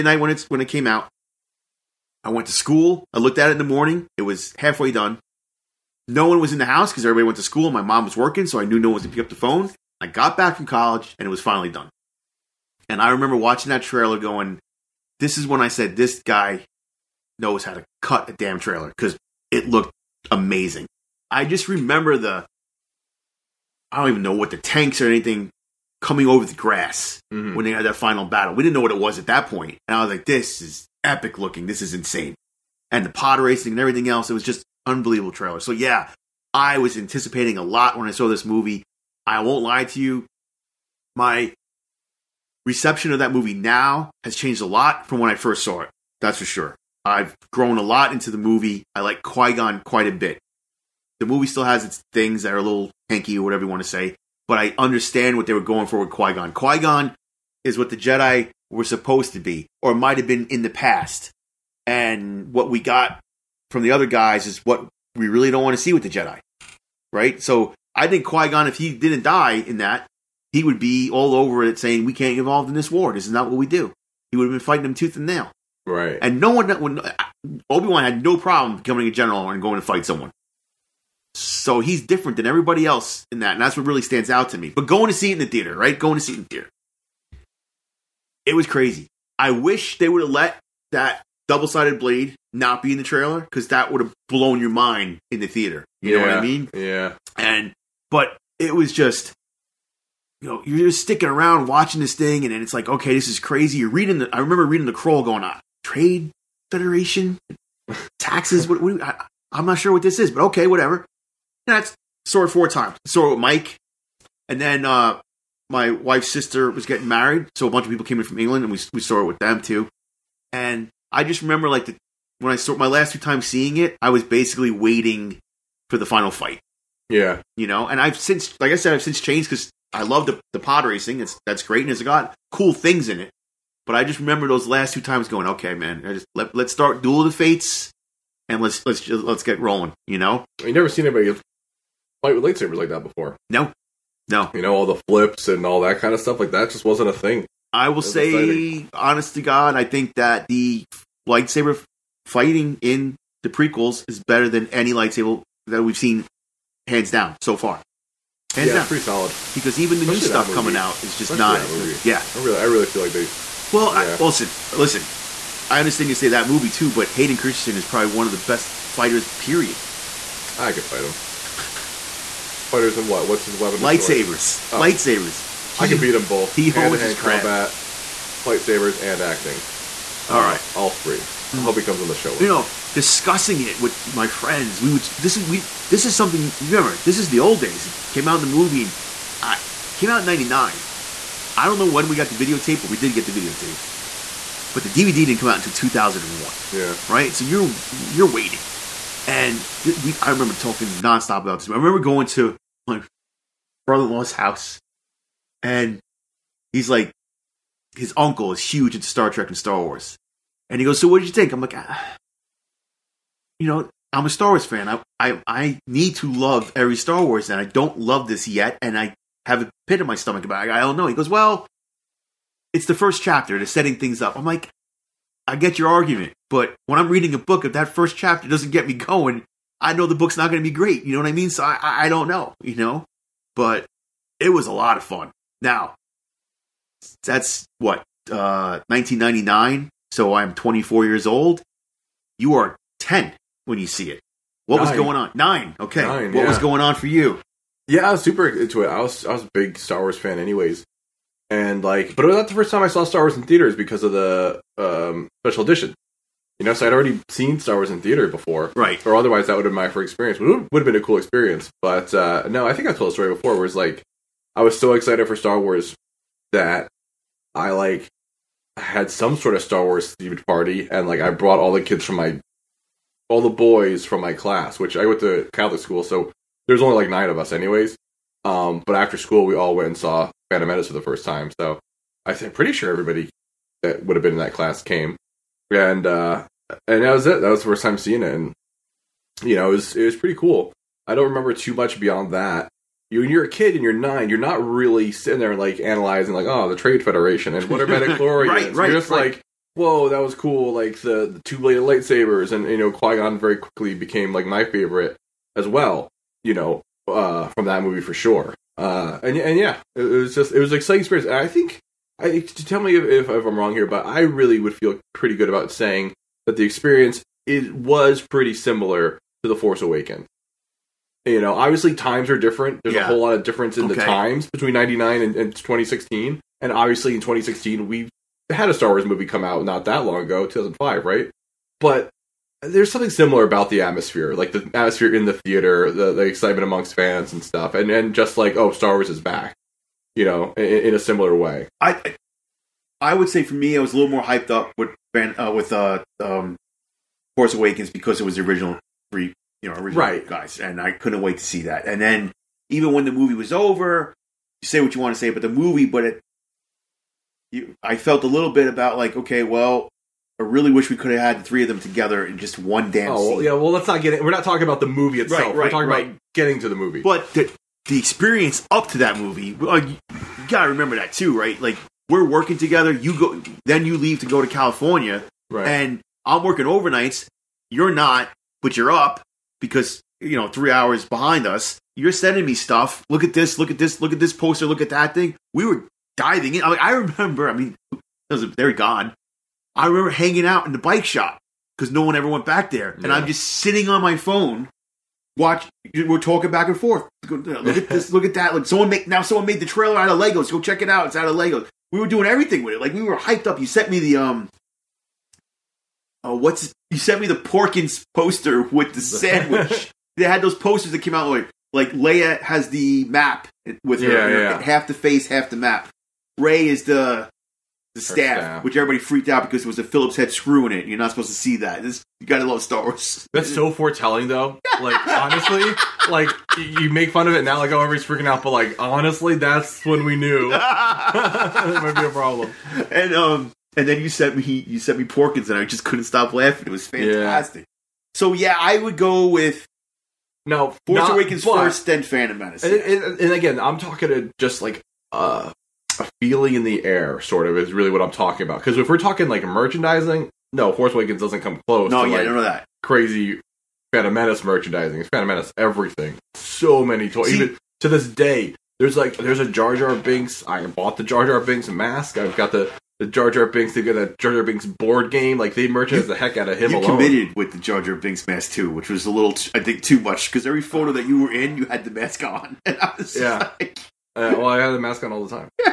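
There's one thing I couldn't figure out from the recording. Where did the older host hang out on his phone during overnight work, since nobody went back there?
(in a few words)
bike shop.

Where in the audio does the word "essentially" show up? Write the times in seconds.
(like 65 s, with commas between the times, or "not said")
not said.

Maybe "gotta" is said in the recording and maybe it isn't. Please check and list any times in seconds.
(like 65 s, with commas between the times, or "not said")
370 s, 422 s.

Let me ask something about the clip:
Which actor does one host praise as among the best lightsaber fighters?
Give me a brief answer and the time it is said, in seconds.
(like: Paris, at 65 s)
Hayden Christensen, at 167 s.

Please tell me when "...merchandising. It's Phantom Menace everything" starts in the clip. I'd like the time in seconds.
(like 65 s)
454 s.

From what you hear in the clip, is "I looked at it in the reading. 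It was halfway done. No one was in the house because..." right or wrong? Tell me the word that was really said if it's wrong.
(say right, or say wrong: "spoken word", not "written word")
wrong: "morning", not "reading".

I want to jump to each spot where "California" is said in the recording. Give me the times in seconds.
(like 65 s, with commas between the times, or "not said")
374 s.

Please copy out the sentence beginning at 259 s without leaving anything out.
Or otherwise, that would have been my first experience.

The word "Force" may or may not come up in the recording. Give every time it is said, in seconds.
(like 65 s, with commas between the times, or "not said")
319 s, 347 s, 440 s, 450 s.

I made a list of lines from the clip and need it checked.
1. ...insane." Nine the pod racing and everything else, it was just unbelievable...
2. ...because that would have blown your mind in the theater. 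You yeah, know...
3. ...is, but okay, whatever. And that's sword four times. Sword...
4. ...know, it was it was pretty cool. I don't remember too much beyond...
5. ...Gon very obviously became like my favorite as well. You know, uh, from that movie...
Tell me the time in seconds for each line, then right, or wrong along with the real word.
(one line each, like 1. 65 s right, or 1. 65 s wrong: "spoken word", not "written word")
1. 31 s wrong: "And", not "Nine"
2. 93 s right
3. 110 s right
4. 289 s right
5. 303 s wrong: "quickly", not "obviously".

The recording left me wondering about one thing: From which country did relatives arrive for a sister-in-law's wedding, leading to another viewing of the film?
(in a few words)
England.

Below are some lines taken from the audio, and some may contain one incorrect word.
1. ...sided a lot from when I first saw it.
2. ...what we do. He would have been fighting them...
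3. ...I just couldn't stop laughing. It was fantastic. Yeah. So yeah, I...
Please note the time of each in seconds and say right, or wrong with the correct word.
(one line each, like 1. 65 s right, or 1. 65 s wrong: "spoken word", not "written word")
1. 44 s wrong: "changed", not "sided"
2. 73 s right
3. 435 s right.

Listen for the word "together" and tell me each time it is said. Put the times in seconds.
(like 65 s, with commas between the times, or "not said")
361 s, 372 s.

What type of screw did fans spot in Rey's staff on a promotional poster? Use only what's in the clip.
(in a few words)
Phillips head.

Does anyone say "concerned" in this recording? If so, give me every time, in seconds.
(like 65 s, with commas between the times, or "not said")
not said.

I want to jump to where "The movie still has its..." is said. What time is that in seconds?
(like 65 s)
51 s.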